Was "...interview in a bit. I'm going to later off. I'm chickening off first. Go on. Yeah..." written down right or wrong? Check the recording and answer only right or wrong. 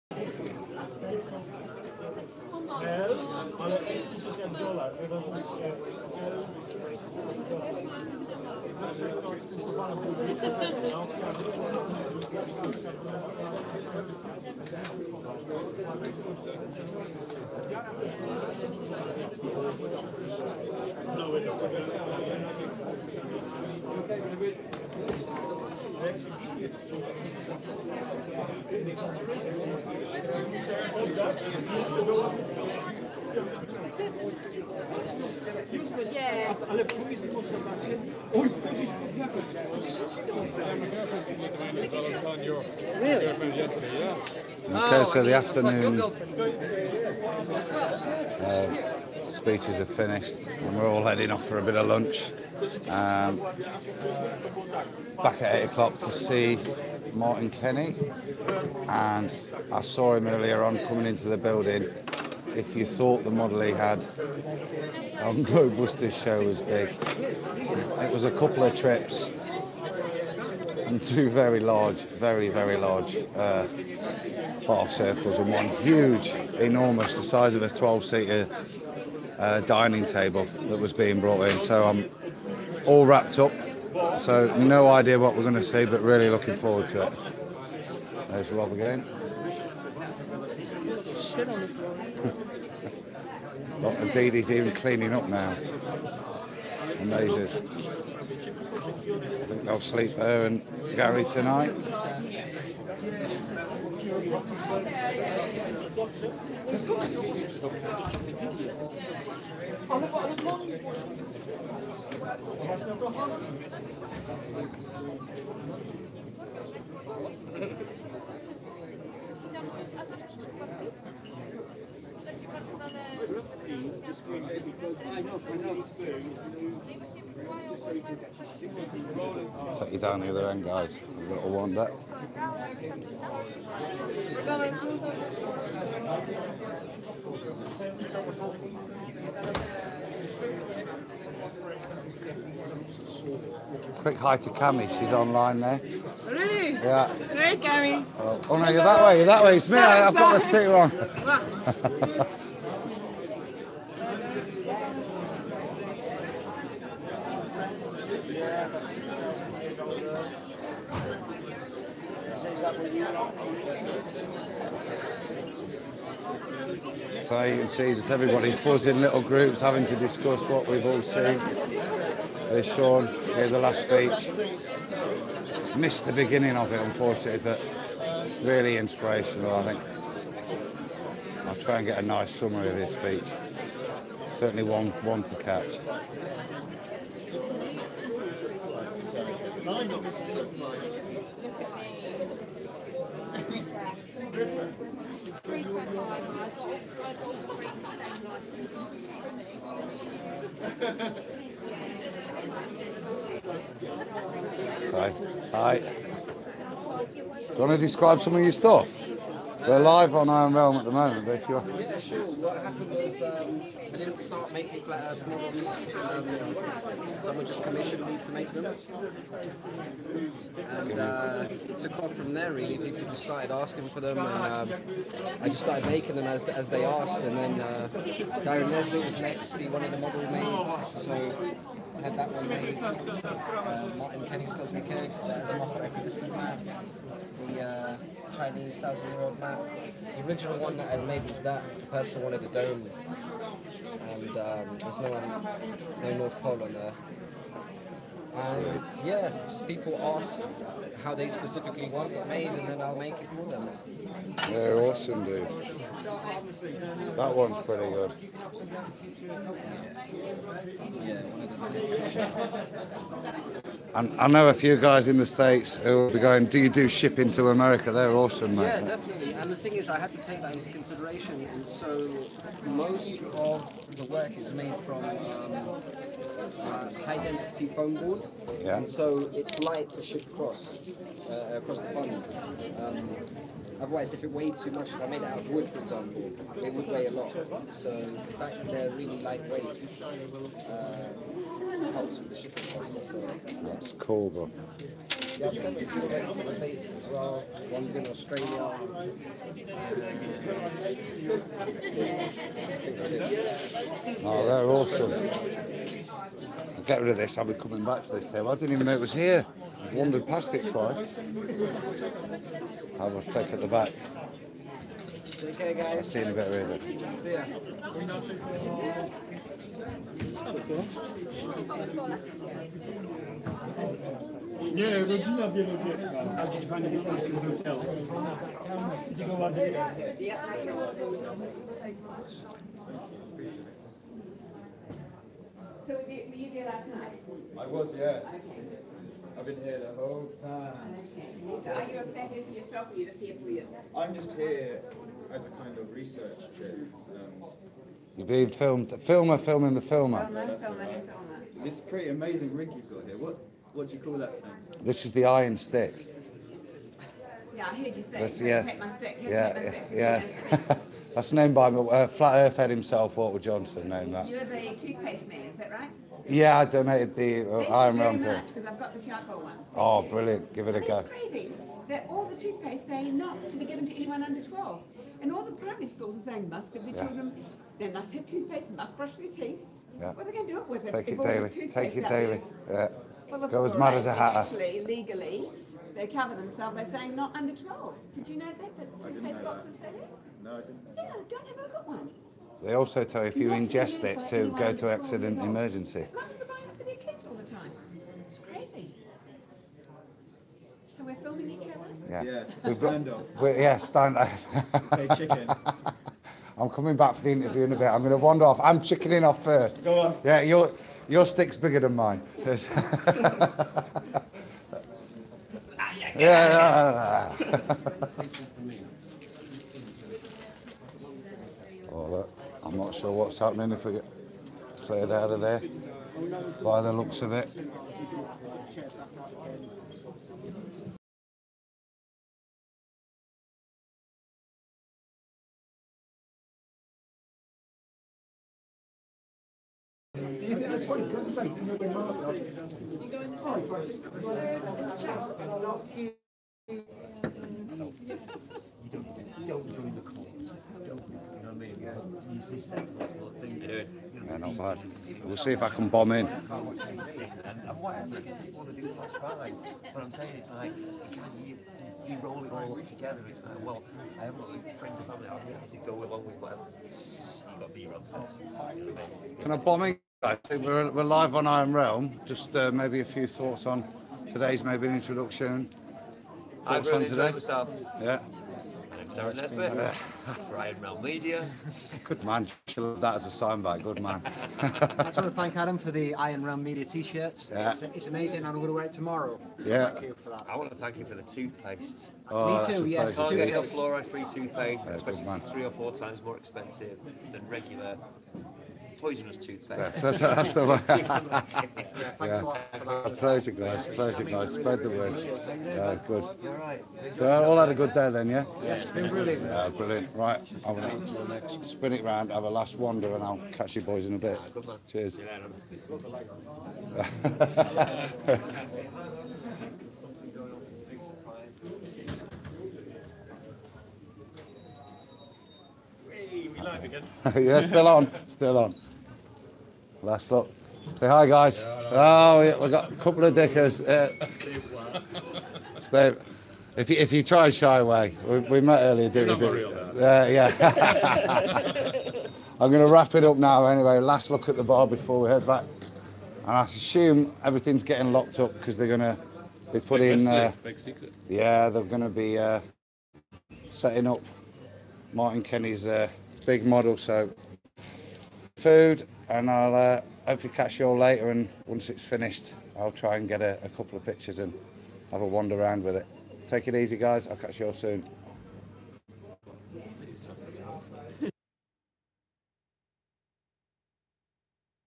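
wrong.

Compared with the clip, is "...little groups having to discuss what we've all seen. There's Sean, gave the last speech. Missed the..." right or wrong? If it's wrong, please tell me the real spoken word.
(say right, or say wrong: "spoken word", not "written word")
right.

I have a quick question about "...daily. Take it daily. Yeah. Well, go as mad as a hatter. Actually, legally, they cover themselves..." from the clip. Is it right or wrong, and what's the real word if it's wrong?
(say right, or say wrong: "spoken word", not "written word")
right.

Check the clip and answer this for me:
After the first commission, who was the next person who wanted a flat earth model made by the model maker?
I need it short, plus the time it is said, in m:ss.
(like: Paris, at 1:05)
Darren Leslie, at 3:48.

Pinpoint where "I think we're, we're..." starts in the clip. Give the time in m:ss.
7:50.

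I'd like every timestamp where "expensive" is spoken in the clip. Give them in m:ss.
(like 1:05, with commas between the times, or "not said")
8:16.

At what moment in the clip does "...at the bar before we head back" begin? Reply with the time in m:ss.
9:04.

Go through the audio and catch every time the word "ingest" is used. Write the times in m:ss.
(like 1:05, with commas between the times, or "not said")
6:33.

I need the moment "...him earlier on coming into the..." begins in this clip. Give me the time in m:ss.
1:00.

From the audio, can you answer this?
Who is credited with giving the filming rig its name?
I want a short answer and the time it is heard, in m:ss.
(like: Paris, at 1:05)
Walter Johnson, at 6:03.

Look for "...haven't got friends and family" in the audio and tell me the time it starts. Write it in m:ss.
7:44.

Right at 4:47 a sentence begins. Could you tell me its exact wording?
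So the fact that they're really lightweight uh, helps with the shipping process.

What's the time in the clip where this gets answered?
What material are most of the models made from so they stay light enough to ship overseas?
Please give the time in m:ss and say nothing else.
4:37.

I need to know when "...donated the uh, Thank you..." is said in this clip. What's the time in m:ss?
6:06.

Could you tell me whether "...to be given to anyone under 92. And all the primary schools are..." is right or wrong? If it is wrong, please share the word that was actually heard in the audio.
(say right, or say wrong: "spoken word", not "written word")
wrong: "12", not "92".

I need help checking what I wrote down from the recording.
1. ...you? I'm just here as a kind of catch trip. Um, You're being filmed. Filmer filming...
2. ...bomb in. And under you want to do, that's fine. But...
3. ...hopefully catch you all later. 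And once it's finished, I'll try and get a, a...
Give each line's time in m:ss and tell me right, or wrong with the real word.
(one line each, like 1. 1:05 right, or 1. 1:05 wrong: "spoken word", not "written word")
1. 5:43 wrong: "research", not "catch"
2. 7:35 wrong: "whatever", not "under"
3. 9:20 right.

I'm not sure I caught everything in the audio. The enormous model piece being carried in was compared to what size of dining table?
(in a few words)
12-seater.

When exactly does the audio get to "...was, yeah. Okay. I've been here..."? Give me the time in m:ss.
5:37.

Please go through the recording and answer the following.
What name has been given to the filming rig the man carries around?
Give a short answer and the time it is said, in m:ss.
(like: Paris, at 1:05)
the iron stick, at 5:55.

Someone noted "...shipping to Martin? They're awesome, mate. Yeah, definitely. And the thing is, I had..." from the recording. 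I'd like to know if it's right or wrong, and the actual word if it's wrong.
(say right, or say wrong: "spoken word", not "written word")
wrong: "America", not "Martin".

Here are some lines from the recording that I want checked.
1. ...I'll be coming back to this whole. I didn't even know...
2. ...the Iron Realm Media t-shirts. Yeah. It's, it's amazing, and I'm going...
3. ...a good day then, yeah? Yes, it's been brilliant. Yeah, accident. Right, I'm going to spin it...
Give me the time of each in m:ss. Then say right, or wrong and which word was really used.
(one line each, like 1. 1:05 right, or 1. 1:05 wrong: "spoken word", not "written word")
1. 5:07 wrong: "table", not "whole"
2. 8:05 right
3. 8:27 wrong: "brilliant", not "accident".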